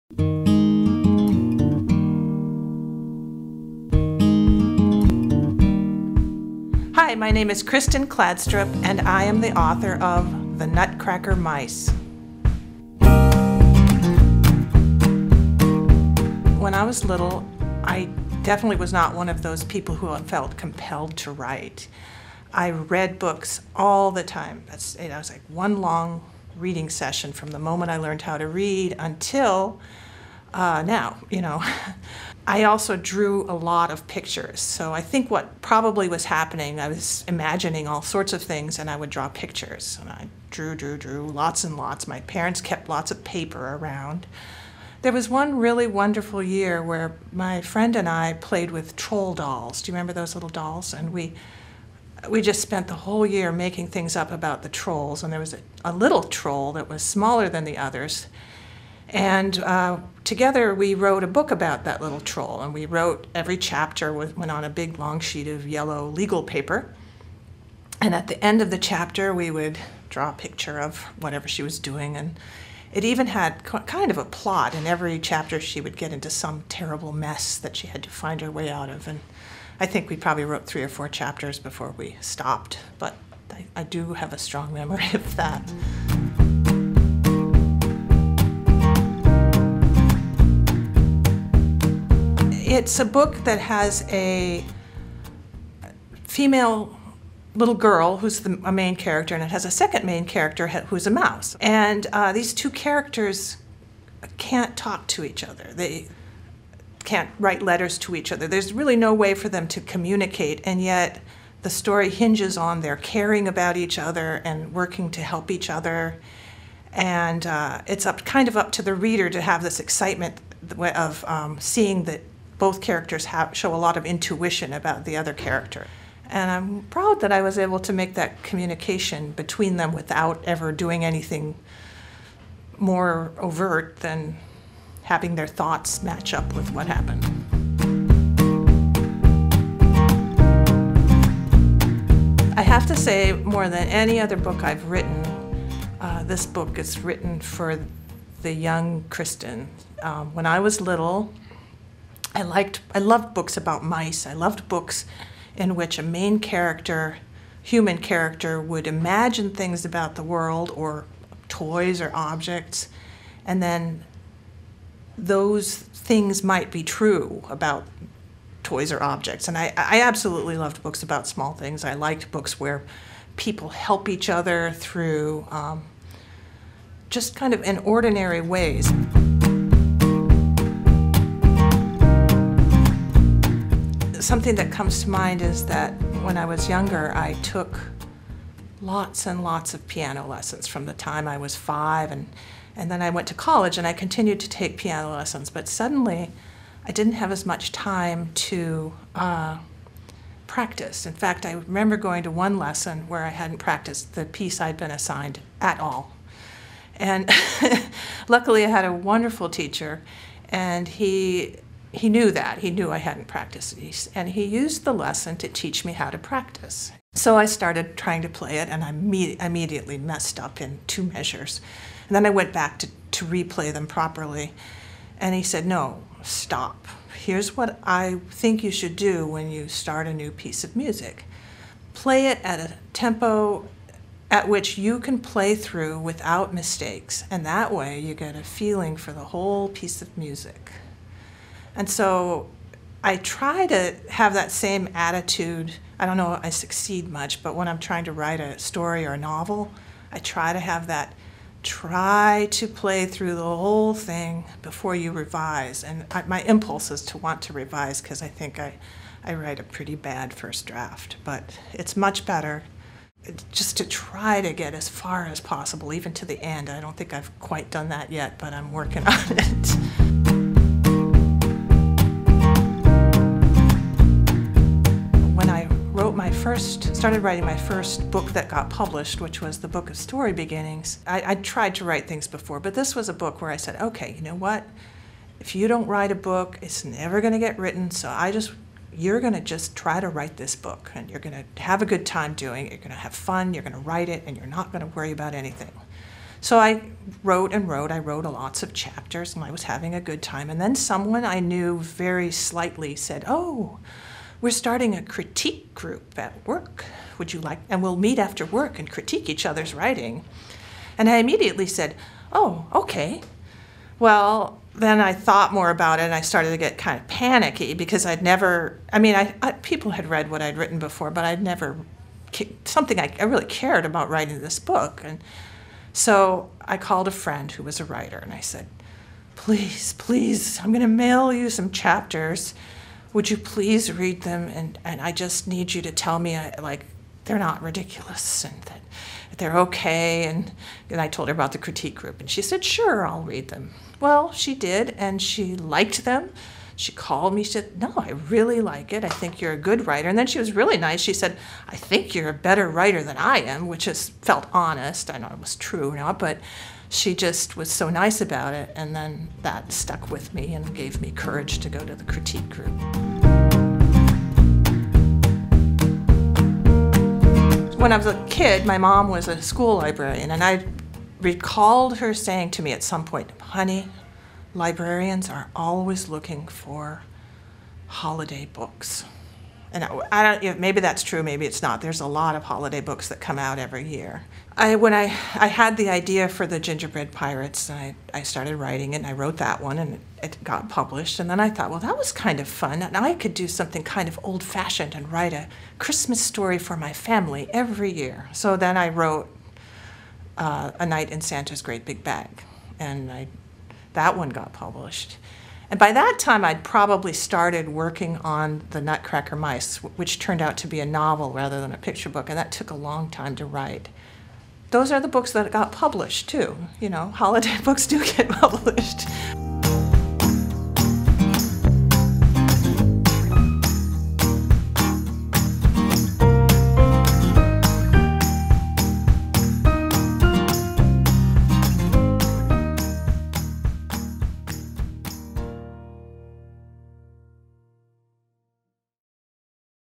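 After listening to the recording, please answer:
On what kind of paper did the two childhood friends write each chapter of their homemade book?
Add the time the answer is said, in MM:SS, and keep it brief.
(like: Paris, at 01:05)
Yellow legal paper, at 01:05.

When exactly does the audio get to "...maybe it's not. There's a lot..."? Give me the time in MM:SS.
06:21.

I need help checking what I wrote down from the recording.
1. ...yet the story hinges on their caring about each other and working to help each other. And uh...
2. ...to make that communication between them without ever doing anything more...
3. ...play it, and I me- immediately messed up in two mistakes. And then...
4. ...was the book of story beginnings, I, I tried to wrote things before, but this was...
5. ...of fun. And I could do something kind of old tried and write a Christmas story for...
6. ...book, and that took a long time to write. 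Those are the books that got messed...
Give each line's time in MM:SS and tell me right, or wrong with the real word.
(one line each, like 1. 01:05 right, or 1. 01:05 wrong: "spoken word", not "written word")
1. 01:50 right
2. 02:07 right
3. 03:38 wrong: "measures", not "mistakes"
4. 04:39 wrong: "write", not "wrote"
5. 06:32 wrong: "fashioned", not "tried"
6. 06:52 wrong: "published", not "messed".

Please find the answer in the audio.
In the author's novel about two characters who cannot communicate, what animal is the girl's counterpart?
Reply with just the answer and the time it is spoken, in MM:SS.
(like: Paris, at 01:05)
Mouse, at 01:41.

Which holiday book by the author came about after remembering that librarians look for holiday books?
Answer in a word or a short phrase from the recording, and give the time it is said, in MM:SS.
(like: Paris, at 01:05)
The Gingerbread Pirates, at 06:26.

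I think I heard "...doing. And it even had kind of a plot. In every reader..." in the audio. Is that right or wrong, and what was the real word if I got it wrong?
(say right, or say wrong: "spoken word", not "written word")
wrong: "chapter", not "reader".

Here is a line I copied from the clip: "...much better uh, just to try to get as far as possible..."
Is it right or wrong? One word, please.
right.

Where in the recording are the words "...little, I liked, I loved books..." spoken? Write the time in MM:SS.
02:30.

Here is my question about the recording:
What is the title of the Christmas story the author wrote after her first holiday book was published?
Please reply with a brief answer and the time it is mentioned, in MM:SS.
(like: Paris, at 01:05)
A Night in Santa's Great Big Bag, at 06:40.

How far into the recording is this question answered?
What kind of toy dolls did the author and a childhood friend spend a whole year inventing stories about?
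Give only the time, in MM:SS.
00:48.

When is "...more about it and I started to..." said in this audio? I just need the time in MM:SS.
05:15.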